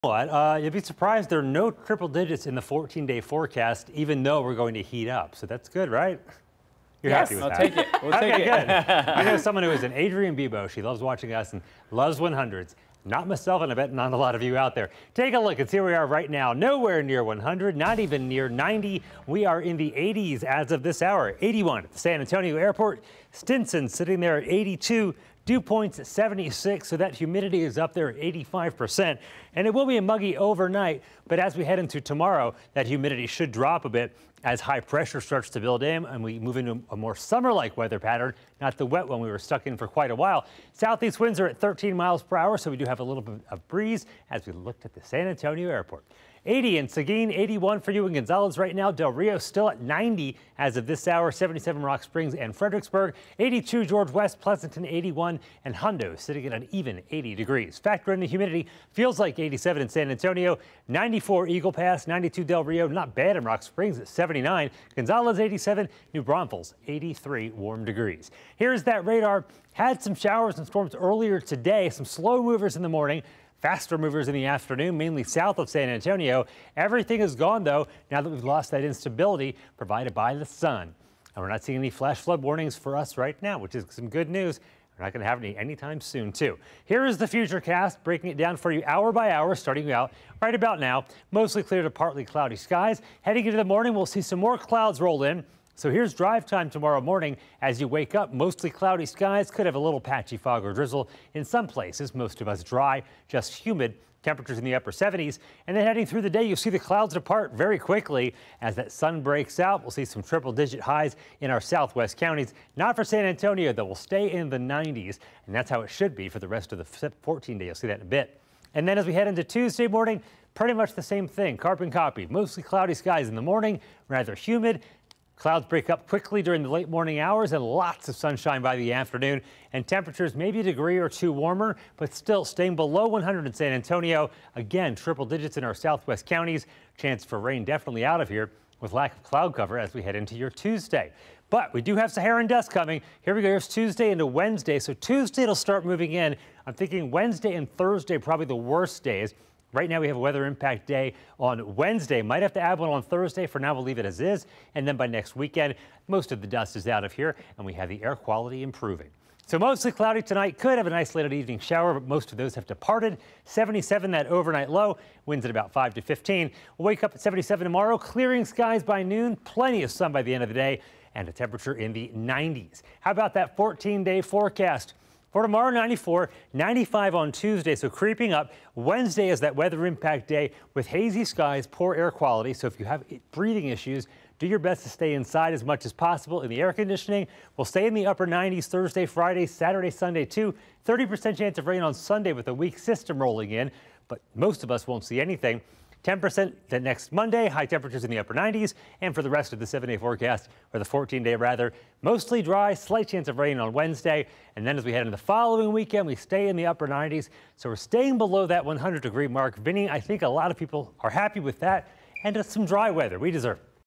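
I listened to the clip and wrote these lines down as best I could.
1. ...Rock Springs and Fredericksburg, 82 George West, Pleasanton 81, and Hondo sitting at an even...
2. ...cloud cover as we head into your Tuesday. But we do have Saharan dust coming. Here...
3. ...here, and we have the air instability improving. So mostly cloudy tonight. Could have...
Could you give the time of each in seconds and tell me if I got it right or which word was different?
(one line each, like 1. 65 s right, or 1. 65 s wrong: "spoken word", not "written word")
1. 51 s right
2. 139 s right
3. 157 s wrong: "quality", not "instability".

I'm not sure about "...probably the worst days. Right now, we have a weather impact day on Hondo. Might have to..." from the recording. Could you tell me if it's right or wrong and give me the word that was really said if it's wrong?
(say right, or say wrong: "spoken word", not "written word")
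wrong: "Wednesday", not "Hondo".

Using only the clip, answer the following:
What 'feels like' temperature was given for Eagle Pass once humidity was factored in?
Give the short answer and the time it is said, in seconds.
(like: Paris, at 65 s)
94, at 60 s.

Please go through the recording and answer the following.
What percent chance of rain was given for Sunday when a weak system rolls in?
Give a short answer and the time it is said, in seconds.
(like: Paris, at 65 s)
30%, at 190 s.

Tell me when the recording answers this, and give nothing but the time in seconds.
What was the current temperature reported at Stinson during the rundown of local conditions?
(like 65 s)
23 s.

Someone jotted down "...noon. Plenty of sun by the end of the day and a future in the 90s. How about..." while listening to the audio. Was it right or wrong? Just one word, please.
wrong.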